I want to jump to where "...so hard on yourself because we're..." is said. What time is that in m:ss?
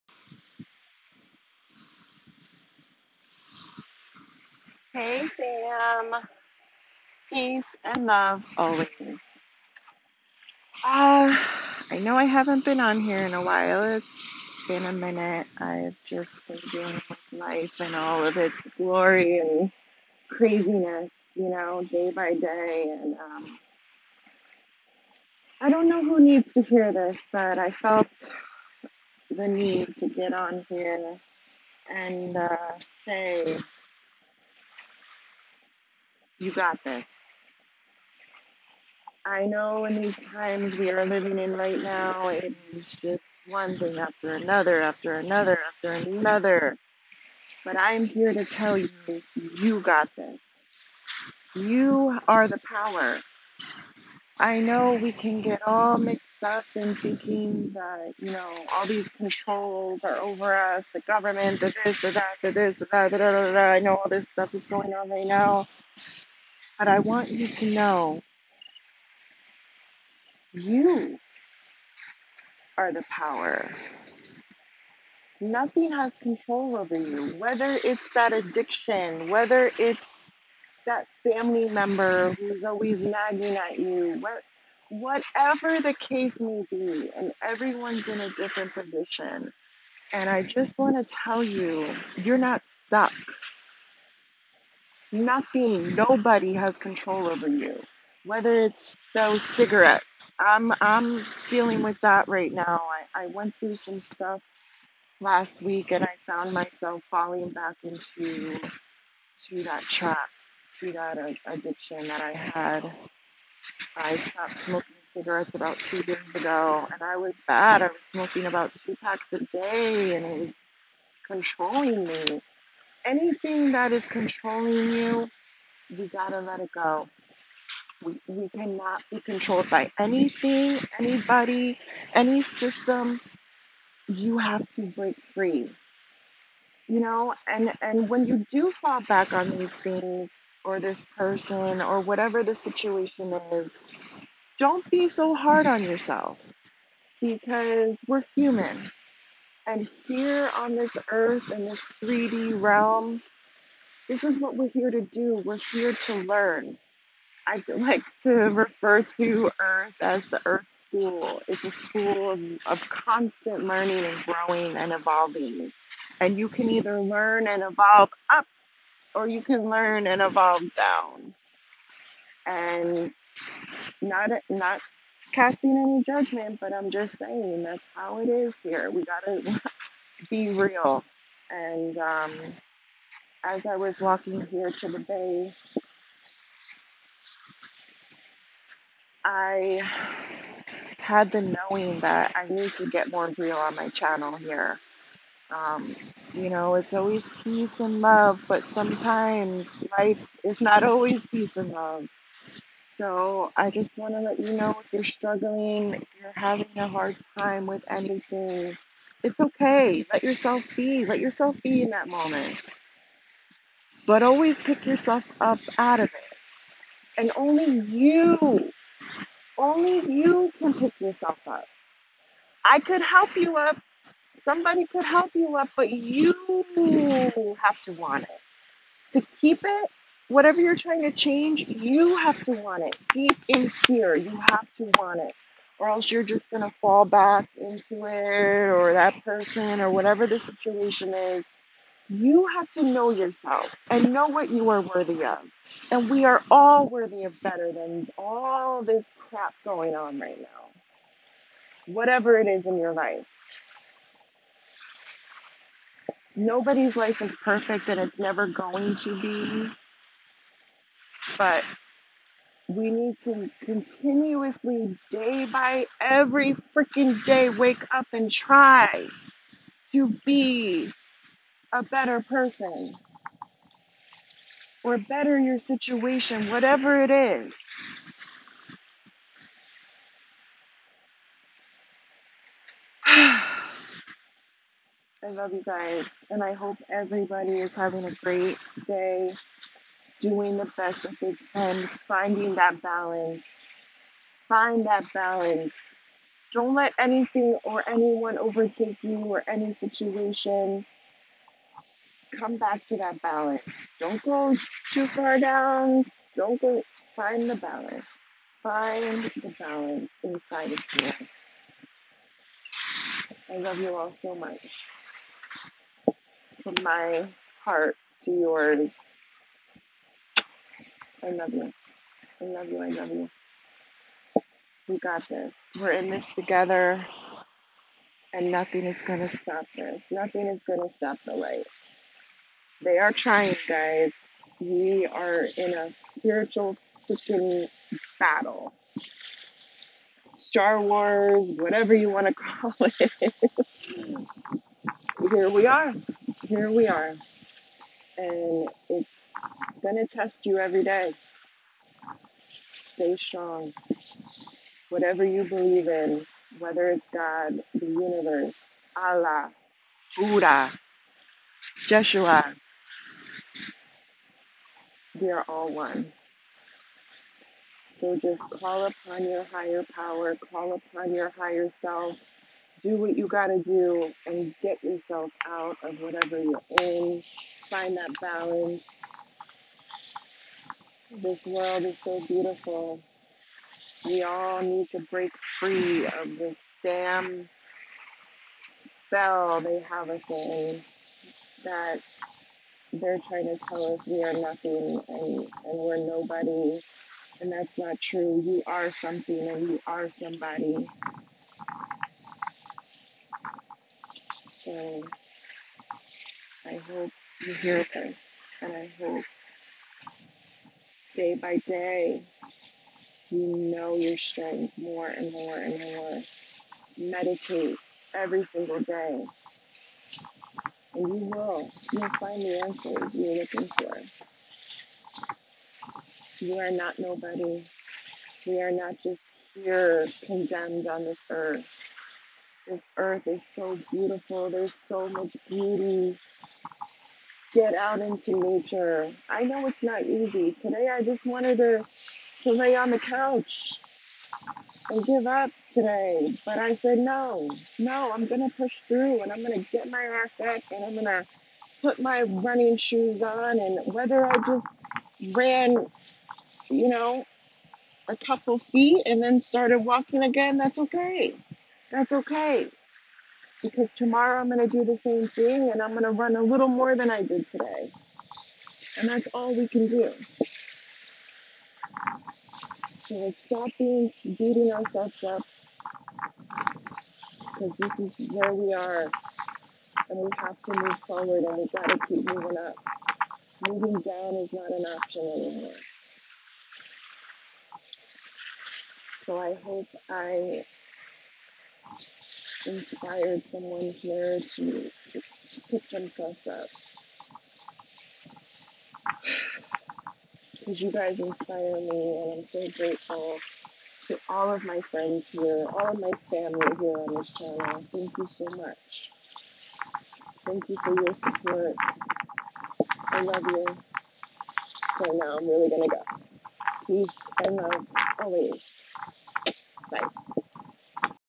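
2:25.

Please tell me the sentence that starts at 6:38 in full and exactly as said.
You are something and you are somebody.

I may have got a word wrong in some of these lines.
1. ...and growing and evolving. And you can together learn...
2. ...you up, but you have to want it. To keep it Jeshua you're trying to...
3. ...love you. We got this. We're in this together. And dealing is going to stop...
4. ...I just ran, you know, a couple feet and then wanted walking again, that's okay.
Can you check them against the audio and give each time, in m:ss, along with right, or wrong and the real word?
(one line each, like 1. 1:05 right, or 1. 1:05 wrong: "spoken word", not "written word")
1. 2:44 wrong: "either", not "together"
2. 3:45 wrong: "Whatever", not "Jeshua"
3. 5:22 wrong: "nothing", not "dealing"
4. 7:34 wrong: "started", not "wanted".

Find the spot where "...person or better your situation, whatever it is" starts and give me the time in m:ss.
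4:32.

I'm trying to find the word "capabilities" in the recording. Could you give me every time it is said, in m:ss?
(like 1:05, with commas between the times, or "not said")
not said.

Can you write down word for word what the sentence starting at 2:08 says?
We, we cannot be controlled by anything, anybody, any system.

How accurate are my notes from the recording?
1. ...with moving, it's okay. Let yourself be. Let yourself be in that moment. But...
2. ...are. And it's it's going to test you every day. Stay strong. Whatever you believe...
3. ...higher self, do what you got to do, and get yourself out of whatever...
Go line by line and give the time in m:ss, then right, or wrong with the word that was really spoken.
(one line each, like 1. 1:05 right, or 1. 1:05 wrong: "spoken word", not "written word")
1. 3:27 wrong: "anything", not "moving"
2. 5:46 right
3. 6:11 right.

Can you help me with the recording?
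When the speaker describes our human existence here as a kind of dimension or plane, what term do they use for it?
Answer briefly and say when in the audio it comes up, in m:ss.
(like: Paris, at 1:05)
3D realm, at 2:32.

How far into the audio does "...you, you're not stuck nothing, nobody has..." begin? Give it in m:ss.
1:31.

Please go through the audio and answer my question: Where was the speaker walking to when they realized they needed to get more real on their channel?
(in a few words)
the bay.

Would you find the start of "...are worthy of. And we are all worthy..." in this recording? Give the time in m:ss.
4:04.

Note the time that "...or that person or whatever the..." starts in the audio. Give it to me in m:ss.
3:58.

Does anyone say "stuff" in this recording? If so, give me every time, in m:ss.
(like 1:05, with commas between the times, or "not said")
1:04, 1:43.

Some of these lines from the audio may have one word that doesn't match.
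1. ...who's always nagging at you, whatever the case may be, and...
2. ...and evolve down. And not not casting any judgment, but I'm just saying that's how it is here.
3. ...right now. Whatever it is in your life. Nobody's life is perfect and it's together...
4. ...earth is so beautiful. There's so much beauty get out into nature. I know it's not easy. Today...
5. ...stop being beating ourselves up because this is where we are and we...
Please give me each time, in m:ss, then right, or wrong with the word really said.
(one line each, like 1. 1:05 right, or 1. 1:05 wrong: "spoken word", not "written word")
1. 1:22 right
2. 2:50 right
3. 4:10 wrong: "never", not "together"
4. 7:12 right
5. 7:53 right.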